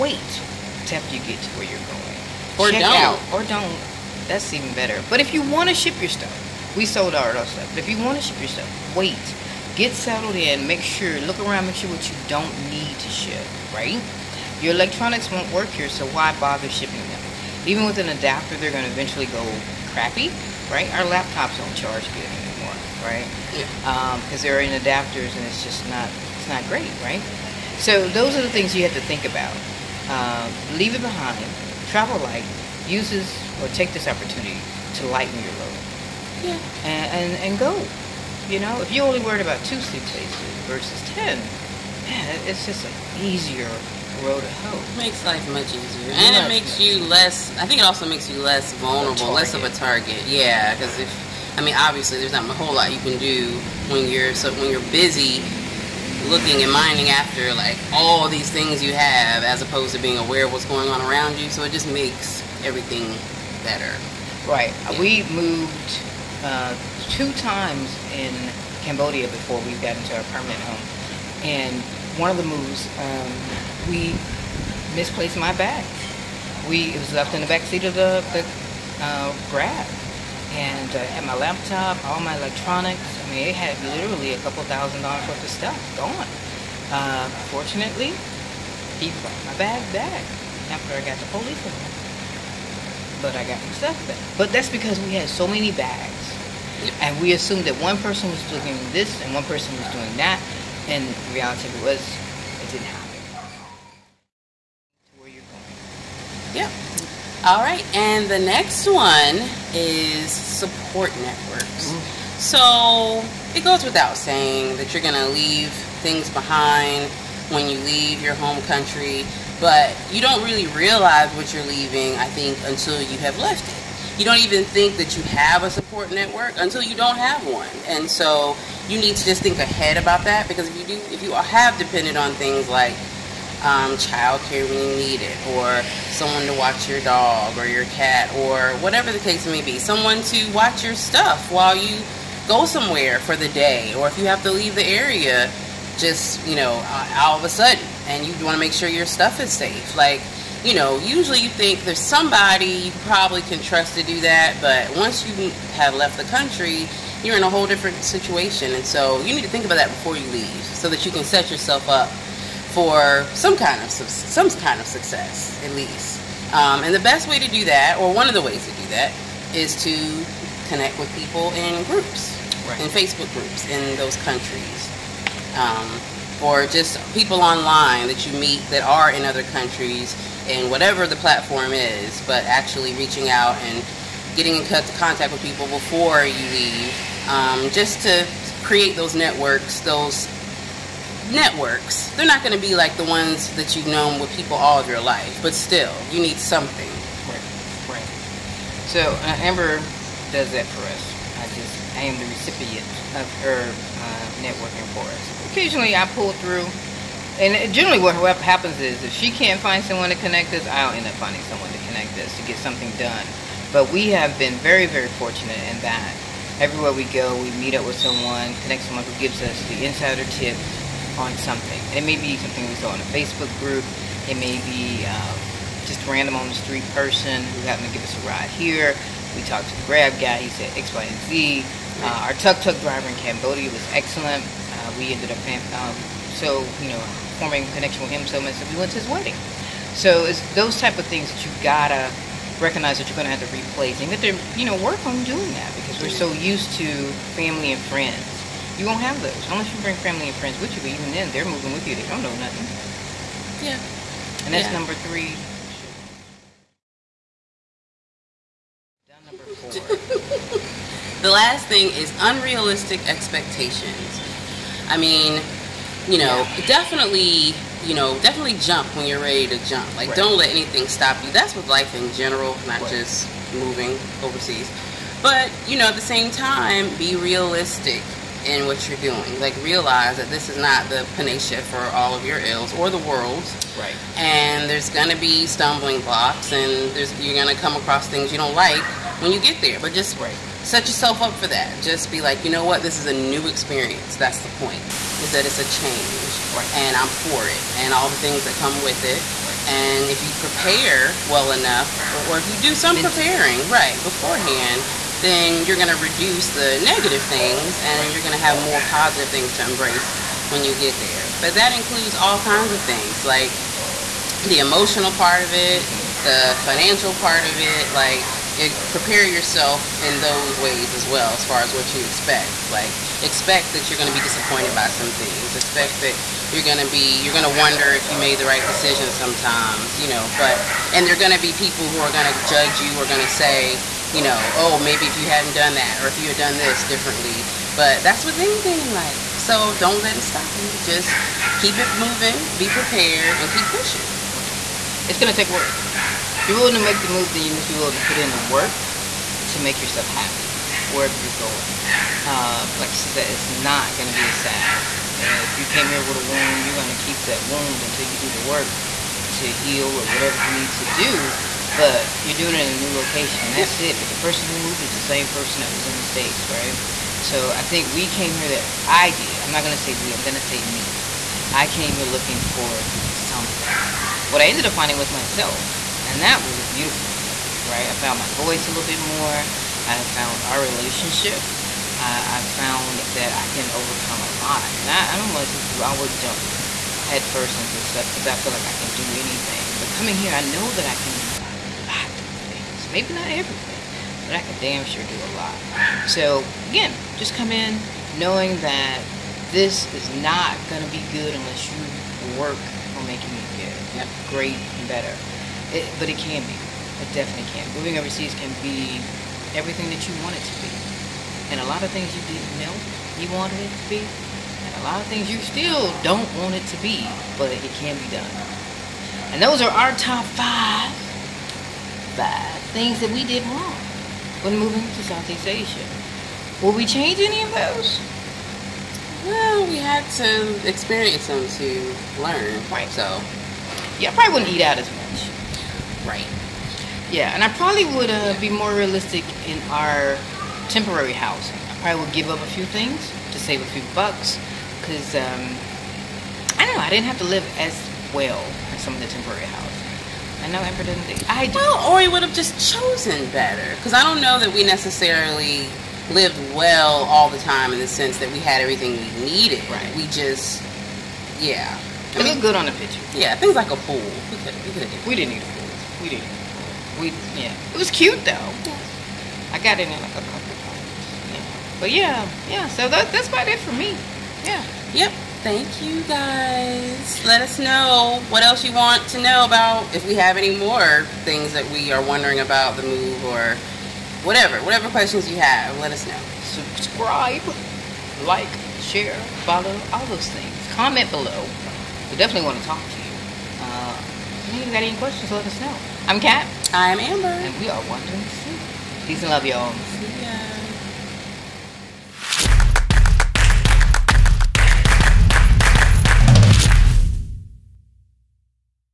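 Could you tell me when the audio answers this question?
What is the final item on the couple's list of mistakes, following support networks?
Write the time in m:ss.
4:22.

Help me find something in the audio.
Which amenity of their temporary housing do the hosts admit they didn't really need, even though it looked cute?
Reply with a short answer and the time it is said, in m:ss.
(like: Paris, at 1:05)
A pool, at 7:43.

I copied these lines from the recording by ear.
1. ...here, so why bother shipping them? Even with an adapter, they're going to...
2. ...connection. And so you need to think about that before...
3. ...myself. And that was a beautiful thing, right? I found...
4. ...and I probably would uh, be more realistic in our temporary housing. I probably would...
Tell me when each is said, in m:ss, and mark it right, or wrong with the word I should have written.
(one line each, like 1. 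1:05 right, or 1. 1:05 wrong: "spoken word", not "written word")
1. 0:15 right
2. 2:37 wrong: "situation", not "connection"
3. 6:15 right
4. 7:17 right.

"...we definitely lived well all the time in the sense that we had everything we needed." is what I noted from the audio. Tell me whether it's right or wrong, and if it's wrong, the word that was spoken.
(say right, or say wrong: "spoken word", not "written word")
wrong: "necessarily", not "definitely".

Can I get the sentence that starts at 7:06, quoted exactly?
Will we change any of those?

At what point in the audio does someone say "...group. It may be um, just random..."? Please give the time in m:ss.
3:43.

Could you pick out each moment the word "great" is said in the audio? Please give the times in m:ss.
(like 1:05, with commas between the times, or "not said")
0:26, 6:44.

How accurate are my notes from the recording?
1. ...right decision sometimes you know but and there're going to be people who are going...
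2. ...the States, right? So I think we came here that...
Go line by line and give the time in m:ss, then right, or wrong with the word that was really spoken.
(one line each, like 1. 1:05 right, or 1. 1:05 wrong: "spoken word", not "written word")
1. 5:28 right
2. 6:05 right.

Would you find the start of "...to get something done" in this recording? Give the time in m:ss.
3:32.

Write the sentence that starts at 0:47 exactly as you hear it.
I think it also makes you less vulnerable, less of a target.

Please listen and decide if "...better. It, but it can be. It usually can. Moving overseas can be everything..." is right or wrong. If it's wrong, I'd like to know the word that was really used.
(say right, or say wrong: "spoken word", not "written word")
wrong: "definitely", not "usually".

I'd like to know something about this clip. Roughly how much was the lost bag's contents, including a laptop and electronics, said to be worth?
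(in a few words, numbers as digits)
A couple thousand dollars.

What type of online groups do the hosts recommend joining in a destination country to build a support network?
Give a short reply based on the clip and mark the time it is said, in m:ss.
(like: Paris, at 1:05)
Facebook groups, at 2:52.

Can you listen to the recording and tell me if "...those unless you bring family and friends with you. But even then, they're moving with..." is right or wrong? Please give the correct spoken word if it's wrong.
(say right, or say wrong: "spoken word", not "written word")
right.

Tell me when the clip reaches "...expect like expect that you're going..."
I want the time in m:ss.
5:22.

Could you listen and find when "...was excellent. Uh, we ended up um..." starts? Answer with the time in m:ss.
3:53.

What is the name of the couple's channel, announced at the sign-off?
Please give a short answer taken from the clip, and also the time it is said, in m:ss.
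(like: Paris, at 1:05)
Wandering Soup, at 8:17.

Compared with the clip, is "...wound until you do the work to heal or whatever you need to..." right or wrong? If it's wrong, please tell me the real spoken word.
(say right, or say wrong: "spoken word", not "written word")
right.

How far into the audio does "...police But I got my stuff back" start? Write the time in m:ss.
1:31.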